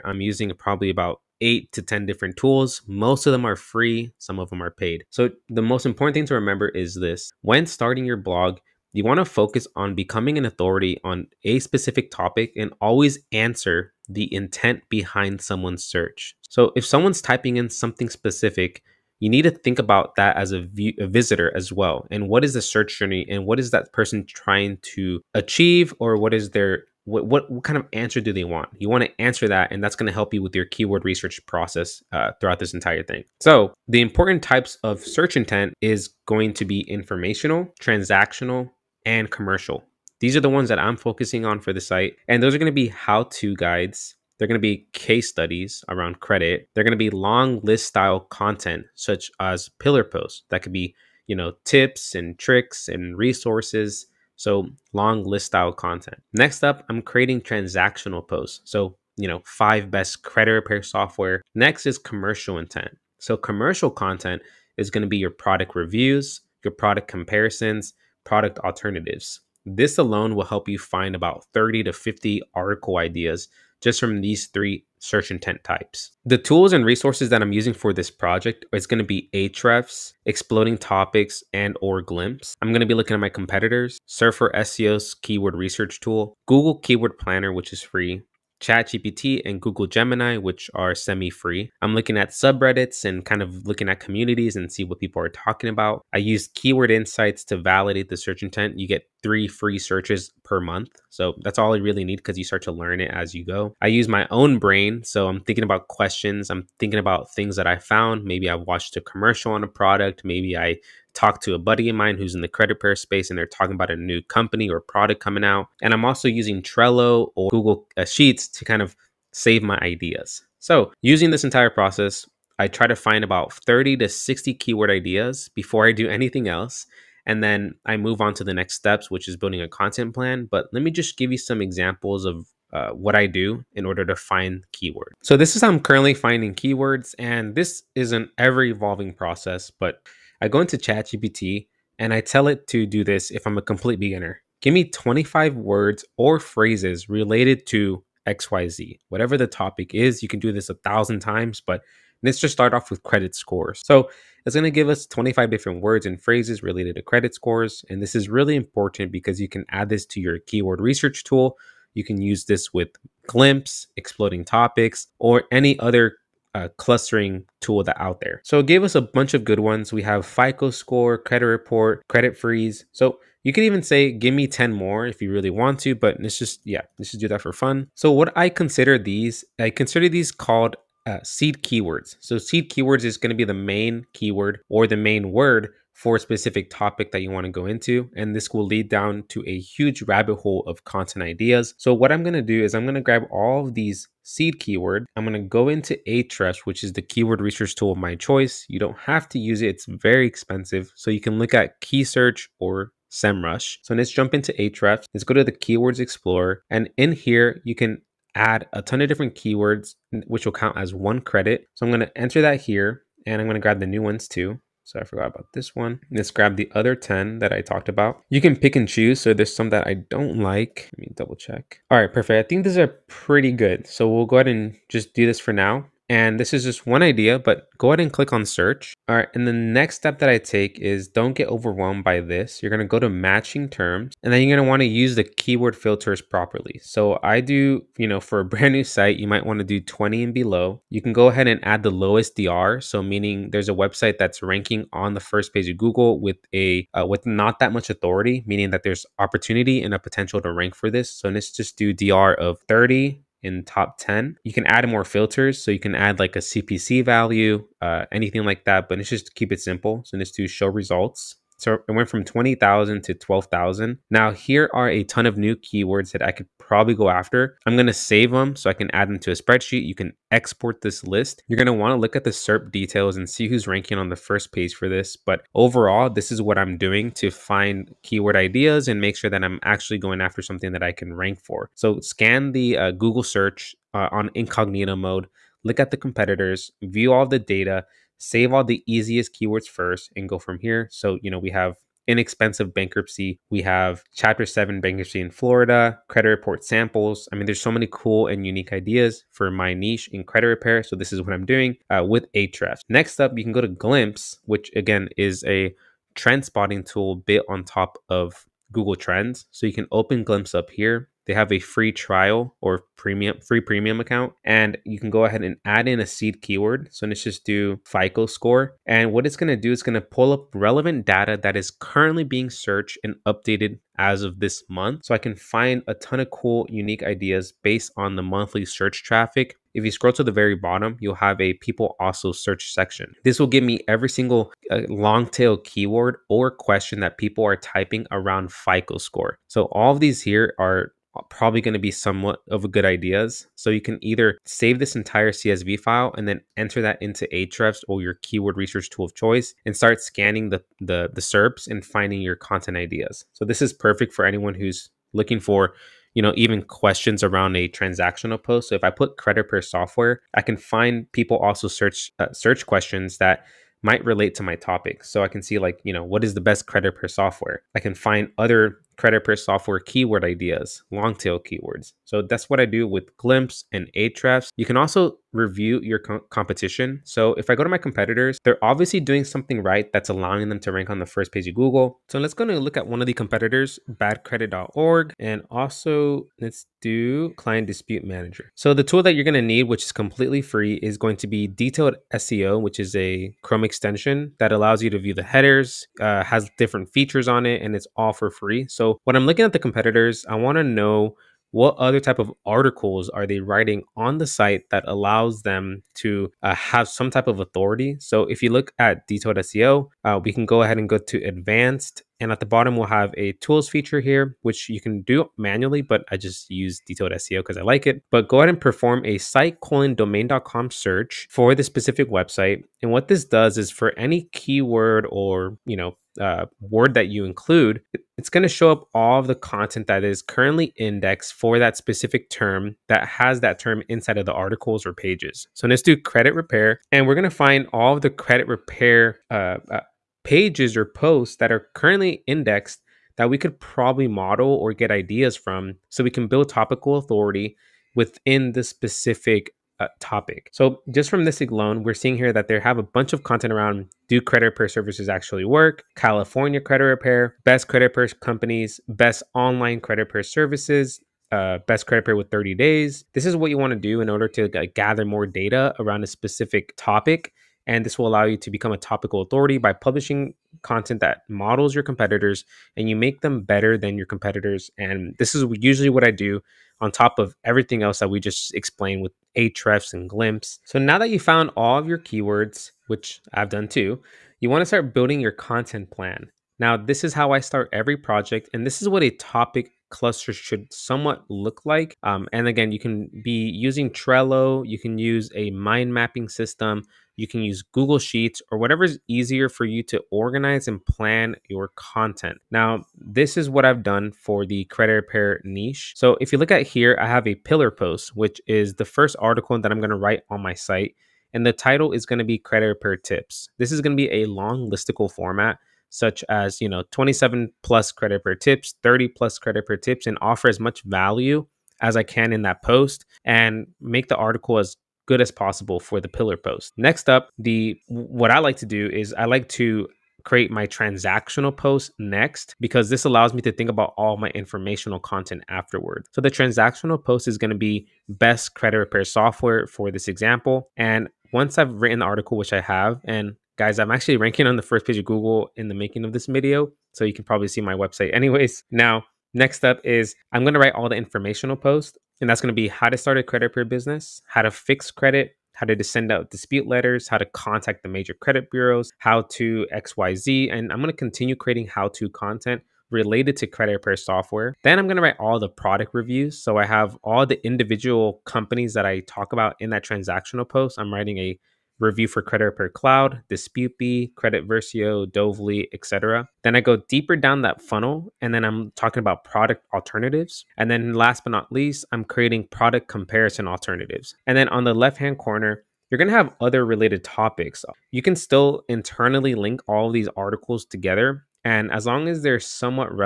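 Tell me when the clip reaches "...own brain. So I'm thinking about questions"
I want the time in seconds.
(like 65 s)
104 s.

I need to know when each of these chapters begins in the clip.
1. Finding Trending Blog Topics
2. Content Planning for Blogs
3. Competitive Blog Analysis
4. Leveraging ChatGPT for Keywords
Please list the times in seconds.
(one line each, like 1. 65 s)
1. 300 s
2. 480 s
3. 373 s
4. 120 s.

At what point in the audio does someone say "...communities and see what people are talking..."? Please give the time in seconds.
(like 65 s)
93 s.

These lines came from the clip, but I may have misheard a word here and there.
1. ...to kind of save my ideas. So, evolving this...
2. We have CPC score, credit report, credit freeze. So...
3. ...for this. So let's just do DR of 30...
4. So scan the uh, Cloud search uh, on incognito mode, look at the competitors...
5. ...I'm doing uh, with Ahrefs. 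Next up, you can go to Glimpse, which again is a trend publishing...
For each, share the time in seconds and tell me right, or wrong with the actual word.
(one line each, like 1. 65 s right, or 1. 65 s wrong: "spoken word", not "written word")
1. 118 s wrong: "using", not "evolving"
2. 169 s wrong: "FICO", not "CPC"
3. 250 s right
4. 281 s wrong: "Google", not "Cloud"
5. 301 s wrong: "spotting", not "publishing".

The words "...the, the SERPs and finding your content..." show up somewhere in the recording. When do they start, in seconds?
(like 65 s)
350 s.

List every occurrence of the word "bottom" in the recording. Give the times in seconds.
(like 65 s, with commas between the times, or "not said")
330 s, 412 s.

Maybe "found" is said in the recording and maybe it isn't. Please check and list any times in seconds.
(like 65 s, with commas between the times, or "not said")
107 s, 481 s.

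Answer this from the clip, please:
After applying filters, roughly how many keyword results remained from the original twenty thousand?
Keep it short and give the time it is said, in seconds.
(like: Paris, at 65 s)
12,000, at 263 s.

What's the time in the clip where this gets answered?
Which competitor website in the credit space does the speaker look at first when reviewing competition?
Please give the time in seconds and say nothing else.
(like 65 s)
383 s.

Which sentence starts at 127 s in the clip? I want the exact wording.
And then I move on to the next steps, which is building a content plan.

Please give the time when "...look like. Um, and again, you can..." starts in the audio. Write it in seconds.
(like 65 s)
491 s.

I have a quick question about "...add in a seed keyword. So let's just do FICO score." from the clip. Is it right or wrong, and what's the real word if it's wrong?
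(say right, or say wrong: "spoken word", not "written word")
right.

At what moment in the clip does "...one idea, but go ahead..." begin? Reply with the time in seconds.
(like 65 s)
226 s.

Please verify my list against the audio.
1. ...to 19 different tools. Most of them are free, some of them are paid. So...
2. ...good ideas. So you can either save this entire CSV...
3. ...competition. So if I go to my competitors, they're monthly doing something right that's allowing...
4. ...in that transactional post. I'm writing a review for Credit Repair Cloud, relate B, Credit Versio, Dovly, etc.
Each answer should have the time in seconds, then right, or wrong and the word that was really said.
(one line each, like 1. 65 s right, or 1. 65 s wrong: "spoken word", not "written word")
1. 1 s wrong: "10", not "19"
2. 342 s right
3. 376 s wrong: "obviously", not "monthly"
4. 569 s wrong: "dispute", not "relate".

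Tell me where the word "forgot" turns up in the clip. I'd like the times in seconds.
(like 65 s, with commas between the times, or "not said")
215 s.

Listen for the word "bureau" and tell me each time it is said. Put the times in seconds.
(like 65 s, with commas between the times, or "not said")
553 s, 558 s.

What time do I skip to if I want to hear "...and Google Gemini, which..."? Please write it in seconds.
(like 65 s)
89 s.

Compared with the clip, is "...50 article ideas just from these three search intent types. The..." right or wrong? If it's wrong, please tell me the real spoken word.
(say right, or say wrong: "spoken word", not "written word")
right.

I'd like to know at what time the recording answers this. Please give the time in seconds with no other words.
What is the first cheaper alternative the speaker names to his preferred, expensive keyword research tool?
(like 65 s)
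201 s.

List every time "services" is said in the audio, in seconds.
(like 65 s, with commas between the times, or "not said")
454 s, 460 s.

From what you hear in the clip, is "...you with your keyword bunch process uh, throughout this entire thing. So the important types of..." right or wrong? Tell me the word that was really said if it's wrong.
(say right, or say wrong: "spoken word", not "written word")
wrong: "research", not "bunch".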